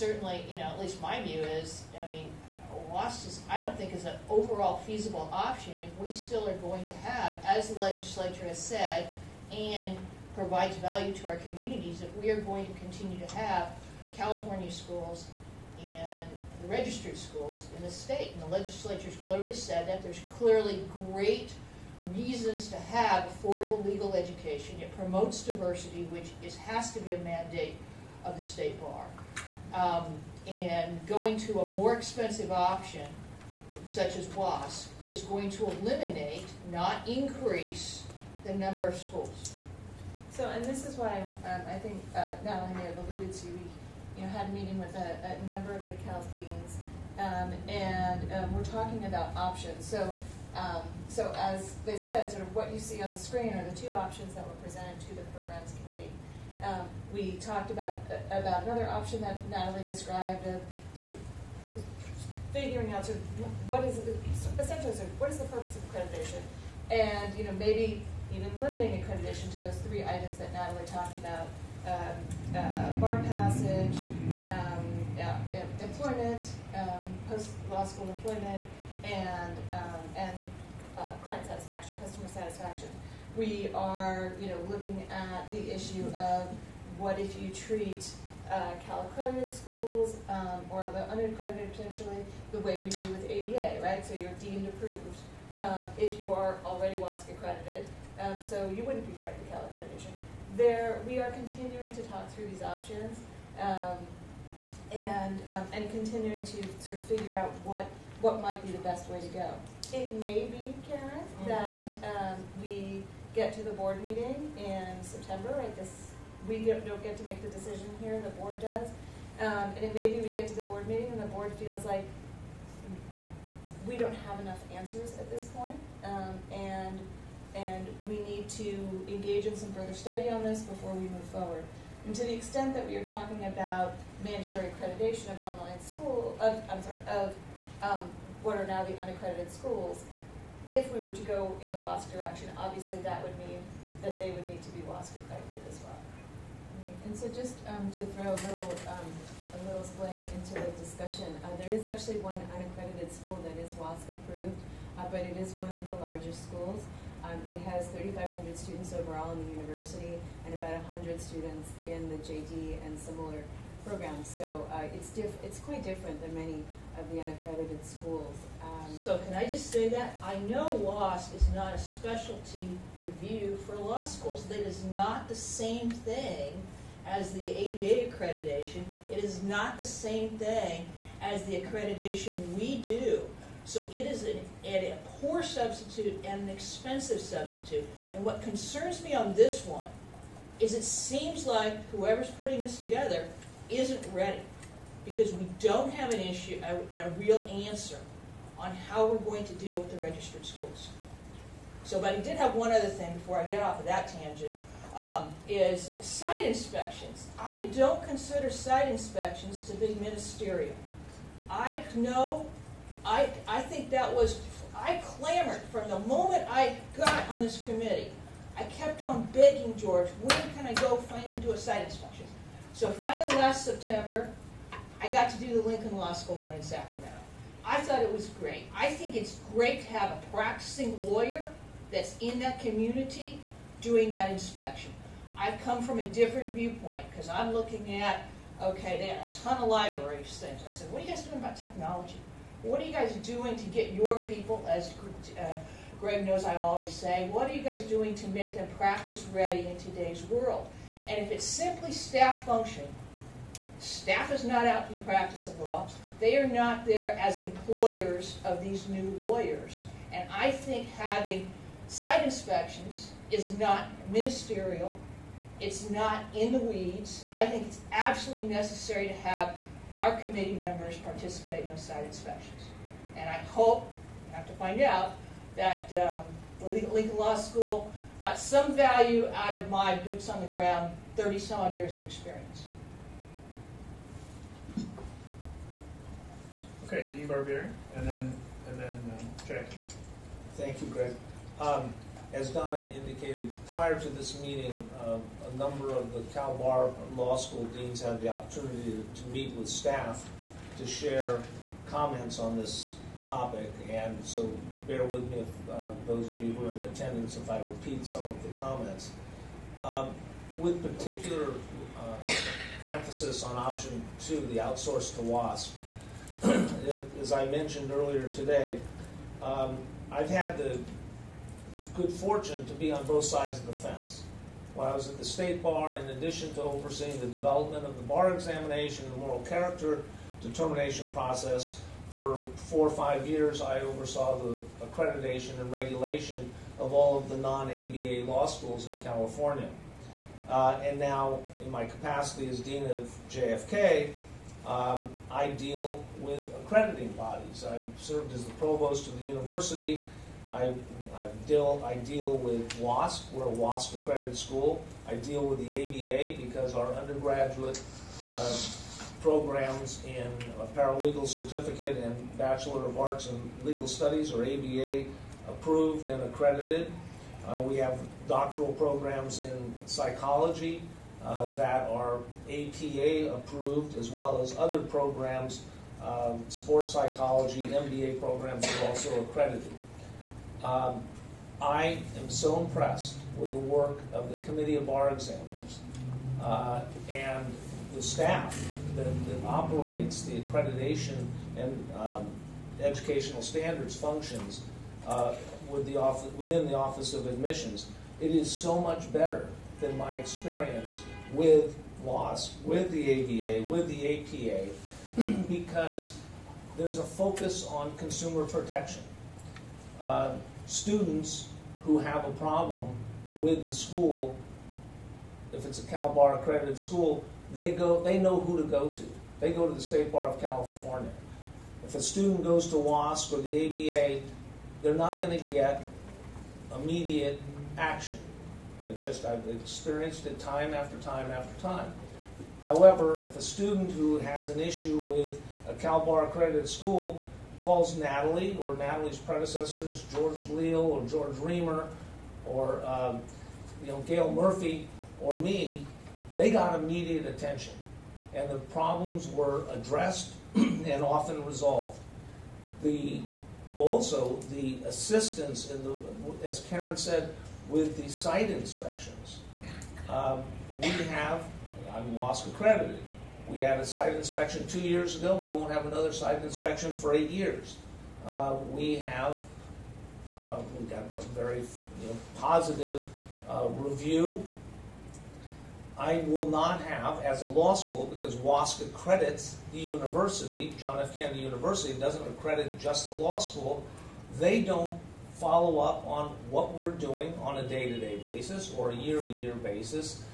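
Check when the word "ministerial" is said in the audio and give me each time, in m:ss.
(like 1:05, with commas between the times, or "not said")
3:30, 4:24.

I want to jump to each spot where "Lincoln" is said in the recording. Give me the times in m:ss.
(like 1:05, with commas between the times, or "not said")
3:45, 4:36.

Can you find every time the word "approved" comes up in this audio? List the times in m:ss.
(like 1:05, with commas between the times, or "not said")
1:34, 2:34, 6:05, 6:13.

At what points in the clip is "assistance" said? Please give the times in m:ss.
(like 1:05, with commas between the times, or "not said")
7:34.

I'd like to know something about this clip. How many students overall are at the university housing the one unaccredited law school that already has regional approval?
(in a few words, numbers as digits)
3,500.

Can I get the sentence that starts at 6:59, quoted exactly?
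They go to the State Bar of California.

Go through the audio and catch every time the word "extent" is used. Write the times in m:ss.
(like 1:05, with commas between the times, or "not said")
2:12.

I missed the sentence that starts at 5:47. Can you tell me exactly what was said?
I've served as the provost of the university.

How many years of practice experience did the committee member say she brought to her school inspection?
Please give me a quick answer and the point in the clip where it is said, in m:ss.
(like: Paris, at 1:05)
30-some, at 4:41.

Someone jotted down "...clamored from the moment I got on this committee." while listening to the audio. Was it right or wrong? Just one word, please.
right.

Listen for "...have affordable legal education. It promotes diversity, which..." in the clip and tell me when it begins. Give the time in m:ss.
0:22.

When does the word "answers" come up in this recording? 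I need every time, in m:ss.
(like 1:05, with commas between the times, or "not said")
2:04, 3:17.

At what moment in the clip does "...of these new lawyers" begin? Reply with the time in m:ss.
4:18.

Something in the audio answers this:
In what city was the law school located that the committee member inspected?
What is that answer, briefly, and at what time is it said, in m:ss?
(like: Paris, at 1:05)
Sacramento, at 3:46.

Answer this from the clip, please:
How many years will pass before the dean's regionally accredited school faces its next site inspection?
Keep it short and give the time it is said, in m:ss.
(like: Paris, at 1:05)
8, at 7:47.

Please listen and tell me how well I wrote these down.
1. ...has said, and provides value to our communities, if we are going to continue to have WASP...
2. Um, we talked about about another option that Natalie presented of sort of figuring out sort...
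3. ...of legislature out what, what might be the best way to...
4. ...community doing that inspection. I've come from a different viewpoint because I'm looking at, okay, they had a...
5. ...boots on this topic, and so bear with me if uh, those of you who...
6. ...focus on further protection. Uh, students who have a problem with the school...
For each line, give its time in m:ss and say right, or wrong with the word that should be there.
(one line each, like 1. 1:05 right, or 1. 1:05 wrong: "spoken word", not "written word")
1. 0:08 wrong: "California", not "WASP"
2. 0:56 wrong: "described", not "presented"
3. 1:46 wrong: "figure", not "legislature"
4. 3:52 right
5. 5:01 wrong: "comments", not "boots"
6. 6:47 wrong: "consumer", not "further".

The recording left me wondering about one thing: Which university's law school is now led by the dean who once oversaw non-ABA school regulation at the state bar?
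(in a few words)
John F. Kennedy University.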